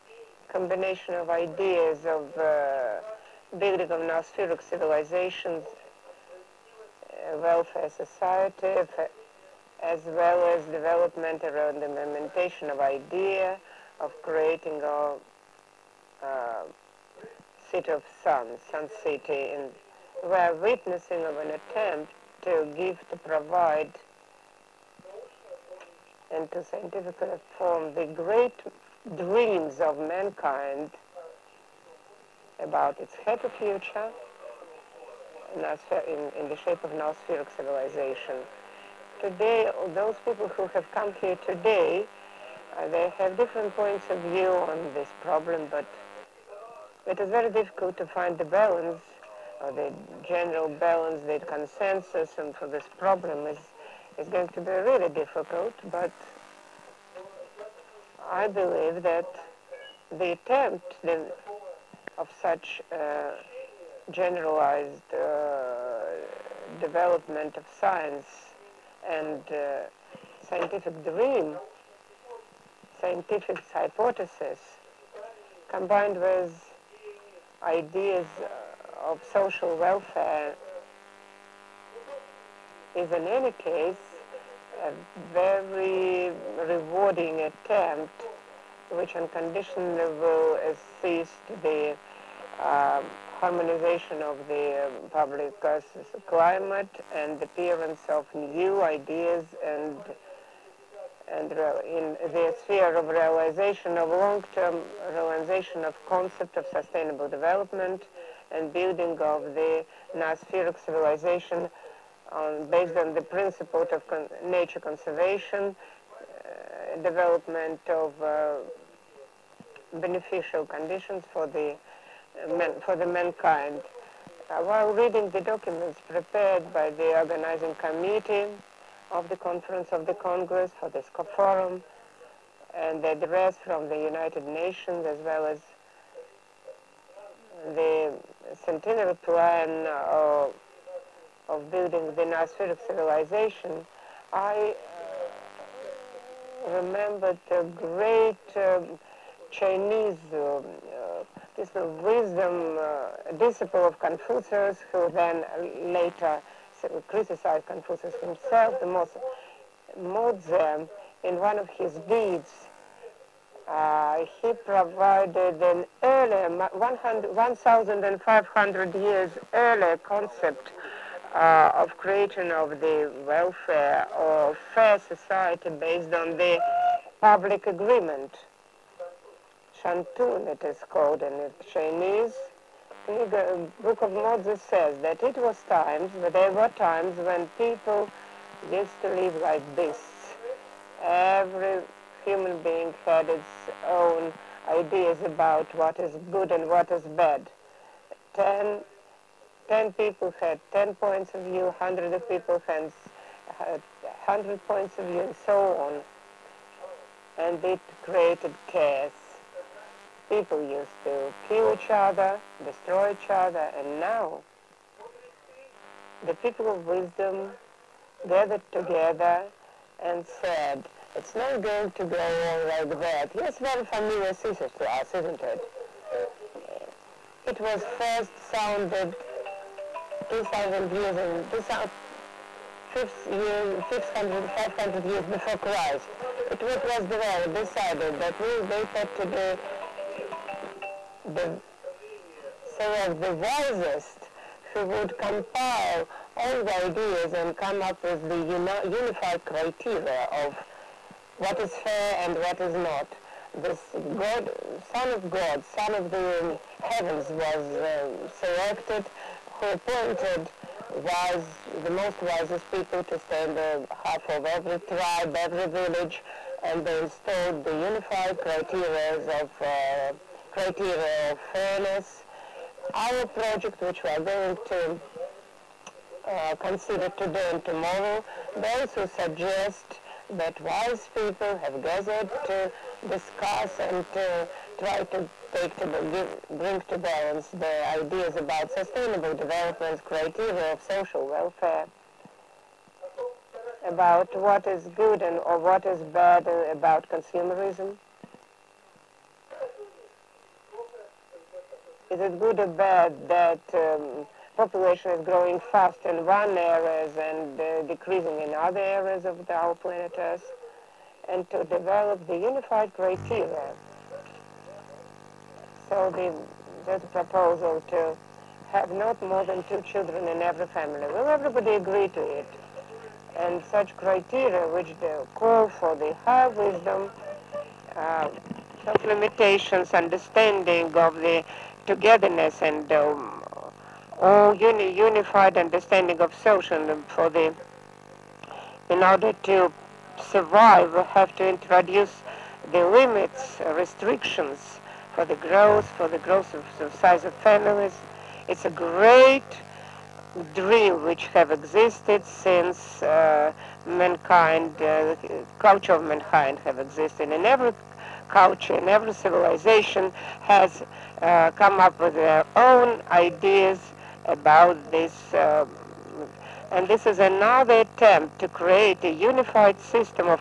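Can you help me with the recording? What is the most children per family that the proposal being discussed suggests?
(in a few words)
2.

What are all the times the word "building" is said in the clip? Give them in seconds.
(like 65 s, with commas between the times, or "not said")
3 s, 108 s, 141 s.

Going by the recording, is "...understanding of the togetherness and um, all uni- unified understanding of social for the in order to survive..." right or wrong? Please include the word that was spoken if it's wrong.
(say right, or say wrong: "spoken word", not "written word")
right.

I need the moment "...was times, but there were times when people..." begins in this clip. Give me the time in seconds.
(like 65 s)
185 s.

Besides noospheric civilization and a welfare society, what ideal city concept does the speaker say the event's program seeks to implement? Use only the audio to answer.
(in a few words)
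City of Sun.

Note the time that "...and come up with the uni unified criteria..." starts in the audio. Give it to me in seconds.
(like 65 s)
247 s.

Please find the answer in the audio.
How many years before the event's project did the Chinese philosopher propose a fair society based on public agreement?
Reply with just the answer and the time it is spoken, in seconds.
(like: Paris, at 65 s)
1,500 years, at 166 s.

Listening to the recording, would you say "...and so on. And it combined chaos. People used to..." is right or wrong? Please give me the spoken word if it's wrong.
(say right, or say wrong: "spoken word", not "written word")
wrong: "created", not "combined".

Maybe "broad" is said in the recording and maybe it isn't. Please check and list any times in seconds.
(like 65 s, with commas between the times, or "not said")
not said.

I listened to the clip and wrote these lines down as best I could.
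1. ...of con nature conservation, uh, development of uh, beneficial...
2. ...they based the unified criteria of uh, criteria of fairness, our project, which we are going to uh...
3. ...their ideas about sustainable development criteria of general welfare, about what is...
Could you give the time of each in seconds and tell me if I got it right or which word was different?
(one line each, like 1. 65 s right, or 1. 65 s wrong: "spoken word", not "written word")
1. 113 s right
2. 266 s wrong: "installed", not "based"
3. 287 s wrong: "social", not "general".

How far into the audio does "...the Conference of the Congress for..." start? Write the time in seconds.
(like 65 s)
129 s.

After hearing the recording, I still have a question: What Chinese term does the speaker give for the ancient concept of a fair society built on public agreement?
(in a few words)
Shantun.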